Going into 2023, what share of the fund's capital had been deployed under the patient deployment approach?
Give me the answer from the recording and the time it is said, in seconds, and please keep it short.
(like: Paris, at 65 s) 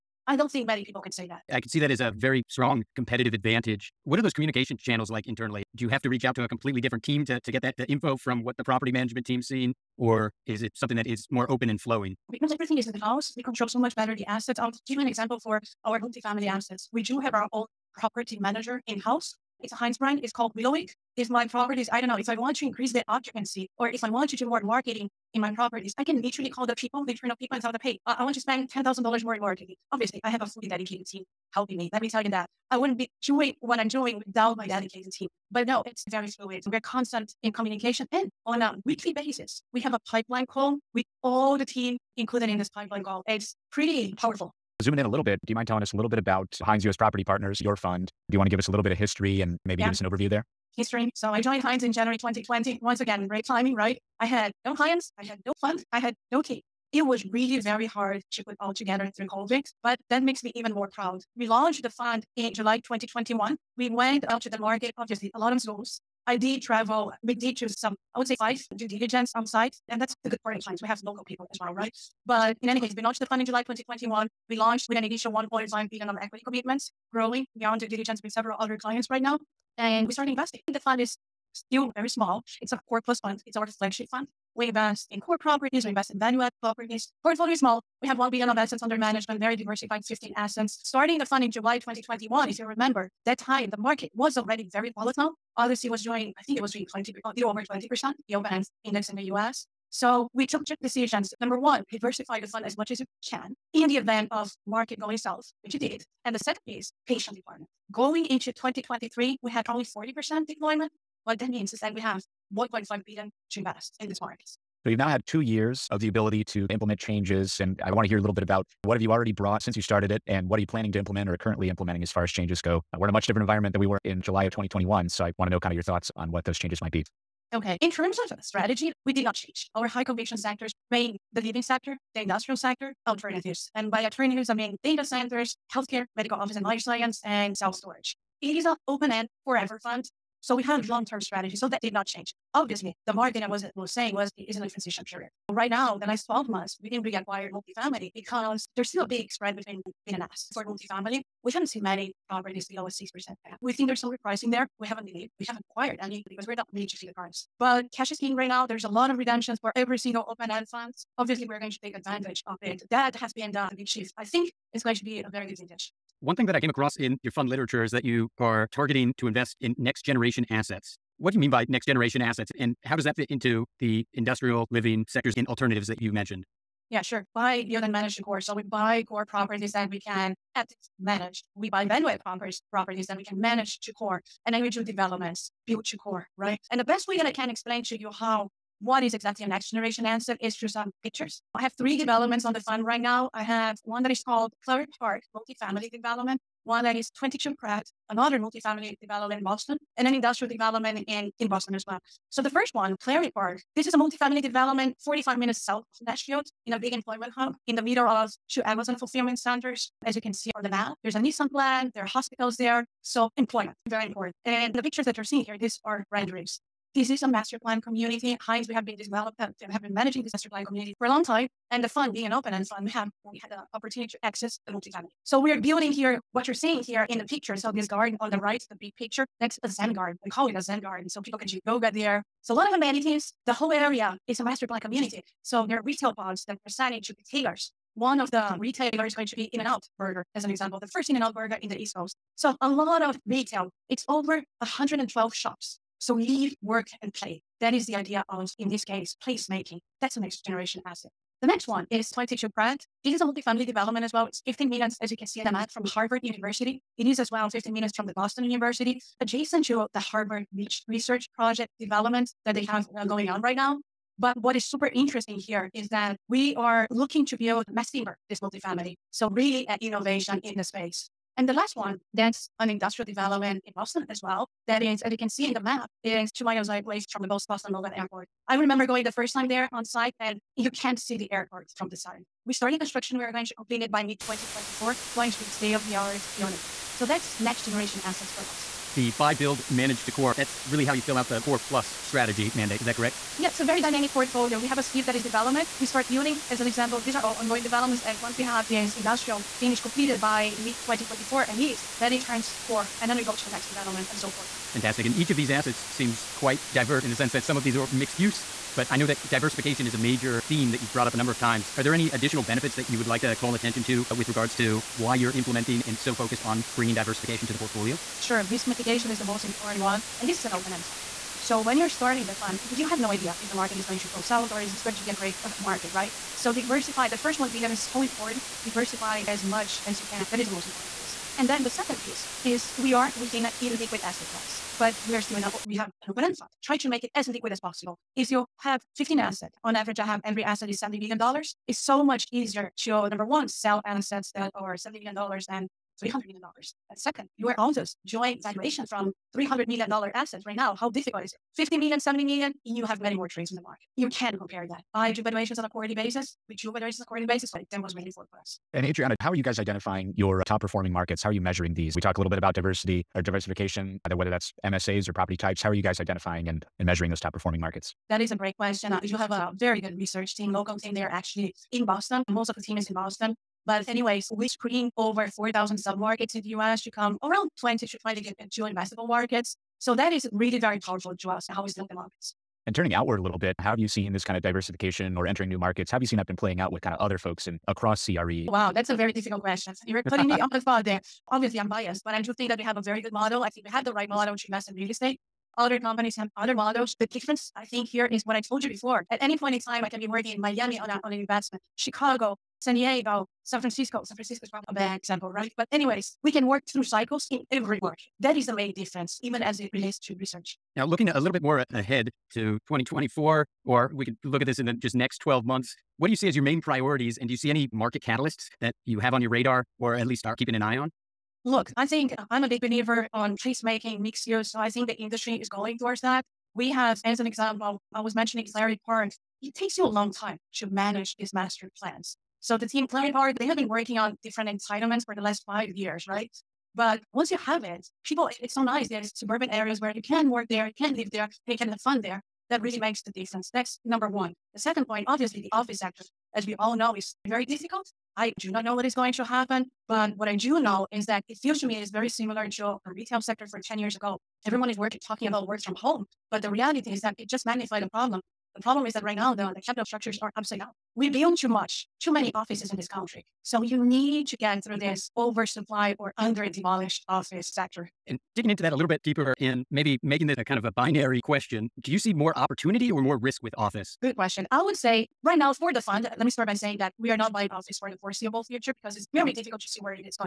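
40%, at 109 s.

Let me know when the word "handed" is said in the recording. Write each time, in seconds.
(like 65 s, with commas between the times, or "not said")
not said.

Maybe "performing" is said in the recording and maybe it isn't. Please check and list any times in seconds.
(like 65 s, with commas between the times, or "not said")
360 s, 367 s.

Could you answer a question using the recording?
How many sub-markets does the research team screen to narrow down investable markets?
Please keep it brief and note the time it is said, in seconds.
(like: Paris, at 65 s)
over 4,000, at 374 s.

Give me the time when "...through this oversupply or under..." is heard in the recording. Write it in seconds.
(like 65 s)
464 s.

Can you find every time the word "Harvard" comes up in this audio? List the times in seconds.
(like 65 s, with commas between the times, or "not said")
255 s, 259 s.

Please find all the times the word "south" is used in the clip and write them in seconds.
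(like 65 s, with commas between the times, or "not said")
105 s, 205 s, 324 s.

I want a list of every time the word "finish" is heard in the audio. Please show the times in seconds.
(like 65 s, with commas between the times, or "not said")
299 s.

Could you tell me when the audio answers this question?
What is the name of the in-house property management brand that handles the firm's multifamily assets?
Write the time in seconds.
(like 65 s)
20 s.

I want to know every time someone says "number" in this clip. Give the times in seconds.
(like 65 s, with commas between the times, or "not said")
101 s, 311 s, 343 s, 443 s.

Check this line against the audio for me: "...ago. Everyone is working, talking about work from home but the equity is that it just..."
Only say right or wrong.
wrong.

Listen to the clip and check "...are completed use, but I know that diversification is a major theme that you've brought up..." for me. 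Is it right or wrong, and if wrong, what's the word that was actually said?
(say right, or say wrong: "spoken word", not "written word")
wrong: "mixed", not "completed".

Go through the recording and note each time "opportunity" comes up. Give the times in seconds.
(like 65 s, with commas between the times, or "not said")
223 s, 472 s.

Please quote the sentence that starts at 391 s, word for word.
Obviously, I'm biased, but I do think that we have a very good model.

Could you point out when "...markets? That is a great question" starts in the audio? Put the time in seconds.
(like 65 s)
367 s.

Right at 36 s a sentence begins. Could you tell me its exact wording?
We're constant in communication and on a weekly basis.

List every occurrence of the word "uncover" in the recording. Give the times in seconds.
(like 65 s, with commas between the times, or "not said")
not said.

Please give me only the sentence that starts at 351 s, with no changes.
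50 million, 70 million, you have many more trades in the market.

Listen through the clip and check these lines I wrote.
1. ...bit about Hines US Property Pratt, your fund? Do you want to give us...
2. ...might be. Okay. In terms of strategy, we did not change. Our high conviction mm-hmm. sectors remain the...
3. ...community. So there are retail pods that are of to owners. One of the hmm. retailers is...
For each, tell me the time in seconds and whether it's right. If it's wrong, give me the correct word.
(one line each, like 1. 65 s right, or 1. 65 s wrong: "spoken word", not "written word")
1. 46 s wrong: "Partners", not "Pratt"
2. 126 s right
3. 234 s wrong: "retailers", not "owners".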